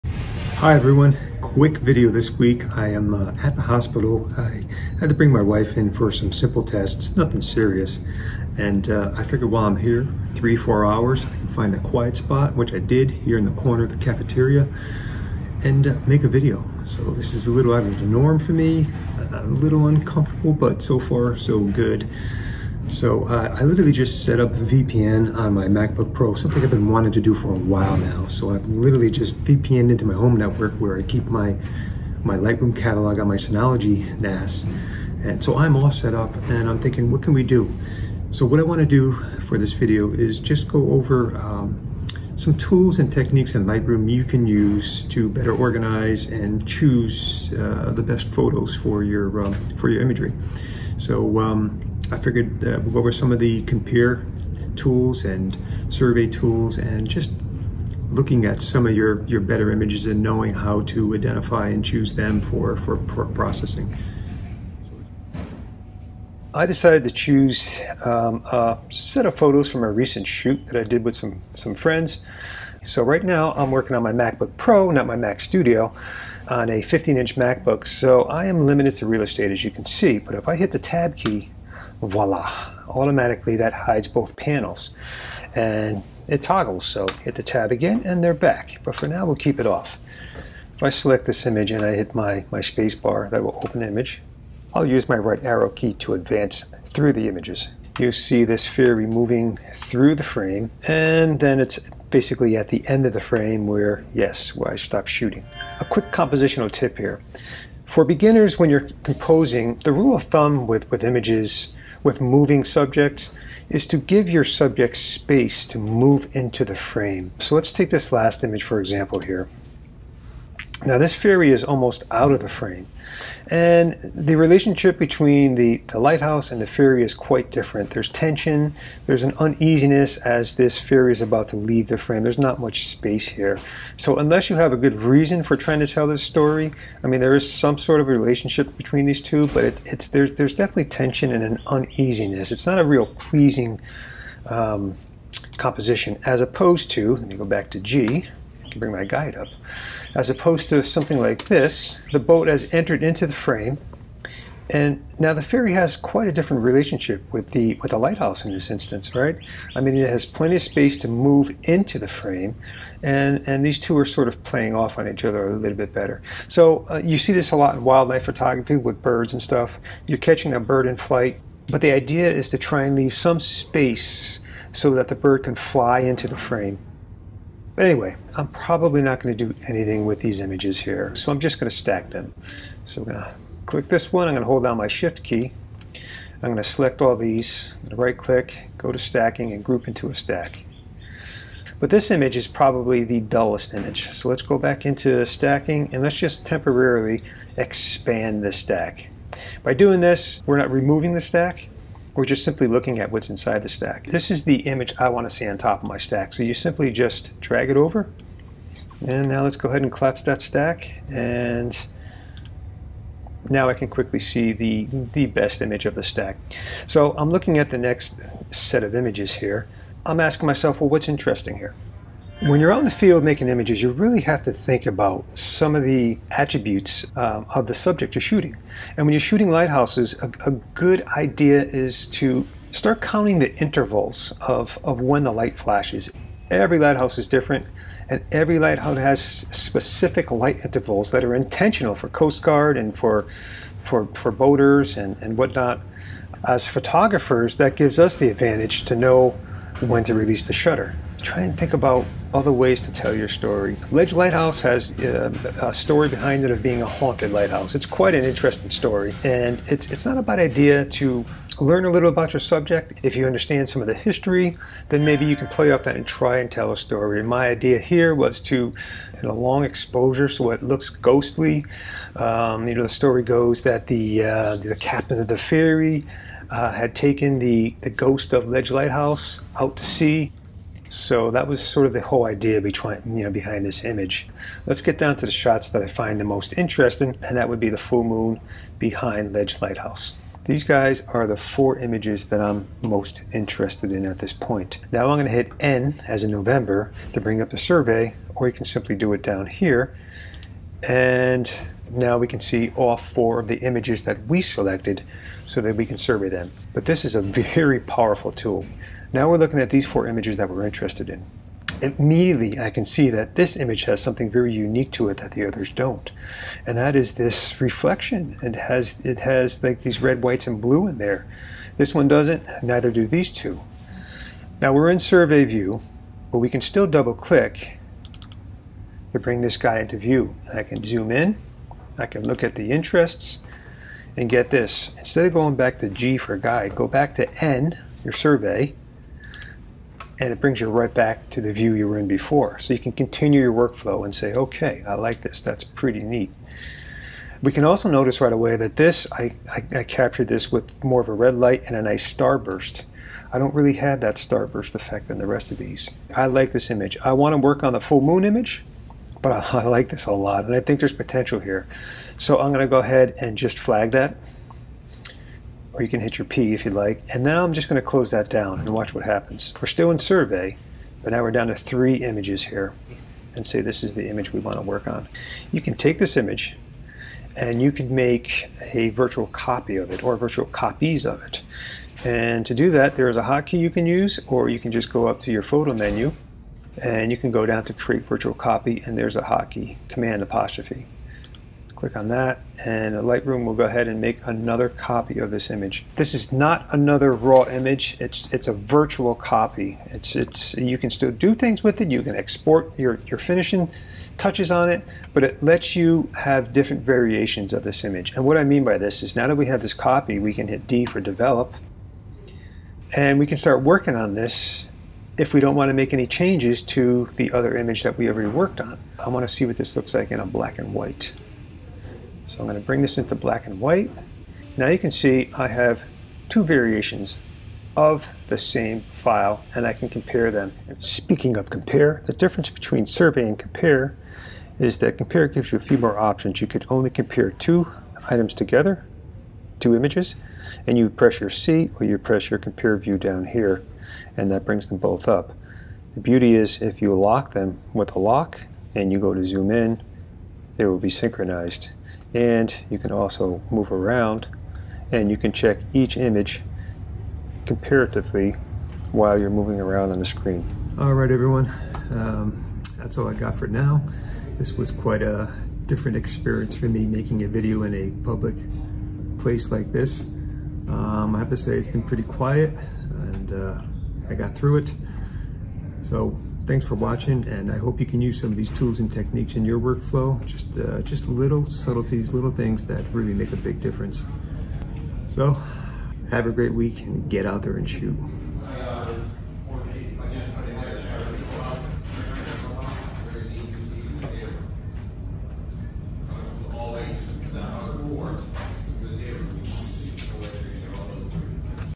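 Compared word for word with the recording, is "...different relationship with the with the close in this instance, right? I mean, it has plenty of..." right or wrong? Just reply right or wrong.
wrong.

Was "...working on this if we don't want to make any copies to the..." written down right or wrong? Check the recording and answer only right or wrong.
wrong.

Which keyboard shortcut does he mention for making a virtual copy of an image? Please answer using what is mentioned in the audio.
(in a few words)
Command apostrophe.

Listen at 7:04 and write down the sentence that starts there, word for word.
Now you can see I have two variations of the same file and I can compare them.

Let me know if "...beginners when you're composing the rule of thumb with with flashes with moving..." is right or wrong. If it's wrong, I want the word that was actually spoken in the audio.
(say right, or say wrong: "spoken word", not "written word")
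wrong: "images", not "flashes".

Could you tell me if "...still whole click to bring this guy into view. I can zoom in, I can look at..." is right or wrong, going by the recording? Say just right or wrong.
wrong.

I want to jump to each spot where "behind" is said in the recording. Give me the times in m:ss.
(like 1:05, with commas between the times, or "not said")
4:16, 4:43, 4:48.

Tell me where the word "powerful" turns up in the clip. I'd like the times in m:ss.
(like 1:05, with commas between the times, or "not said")
5:07.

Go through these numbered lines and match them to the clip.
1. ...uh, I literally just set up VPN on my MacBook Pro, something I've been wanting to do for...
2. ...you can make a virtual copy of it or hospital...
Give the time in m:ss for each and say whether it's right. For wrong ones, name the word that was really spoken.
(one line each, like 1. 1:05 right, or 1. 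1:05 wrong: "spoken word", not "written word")
1. 0:23 right
2. 6:17 wrong: "virtual", not "hospital".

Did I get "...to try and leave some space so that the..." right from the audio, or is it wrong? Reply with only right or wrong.
right.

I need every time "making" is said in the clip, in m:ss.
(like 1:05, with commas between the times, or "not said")
3:43, 7:46.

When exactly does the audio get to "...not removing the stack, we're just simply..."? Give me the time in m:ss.
3:20.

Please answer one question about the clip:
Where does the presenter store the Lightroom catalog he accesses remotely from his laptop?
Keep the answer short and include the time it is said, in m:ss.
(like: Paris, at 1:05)
Synology NAS, at 0:33.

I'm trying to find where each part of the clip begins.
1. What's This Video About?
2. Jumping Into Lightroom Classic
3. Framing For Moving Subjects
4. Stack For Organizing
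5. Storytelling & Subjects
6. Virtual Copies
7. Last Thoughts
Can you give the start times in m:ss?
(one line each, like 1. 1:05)
1. 0:36
2. 1:05
3. 1:44
4. 3:00
5. 3:40
6. 6:13
7. 7:40.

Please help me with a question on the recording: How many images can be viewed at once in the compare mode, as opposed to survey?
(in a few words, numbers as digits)
2.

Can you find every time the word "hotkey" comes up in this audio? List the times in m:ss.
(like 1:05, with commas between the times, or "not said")
6:23, 6:29.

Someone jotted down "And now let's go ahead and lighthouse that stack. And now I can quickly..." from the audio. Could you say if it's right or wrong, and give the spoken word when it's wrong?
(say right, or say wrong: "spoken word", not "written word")
wrong: "collapse", not "lighthouse".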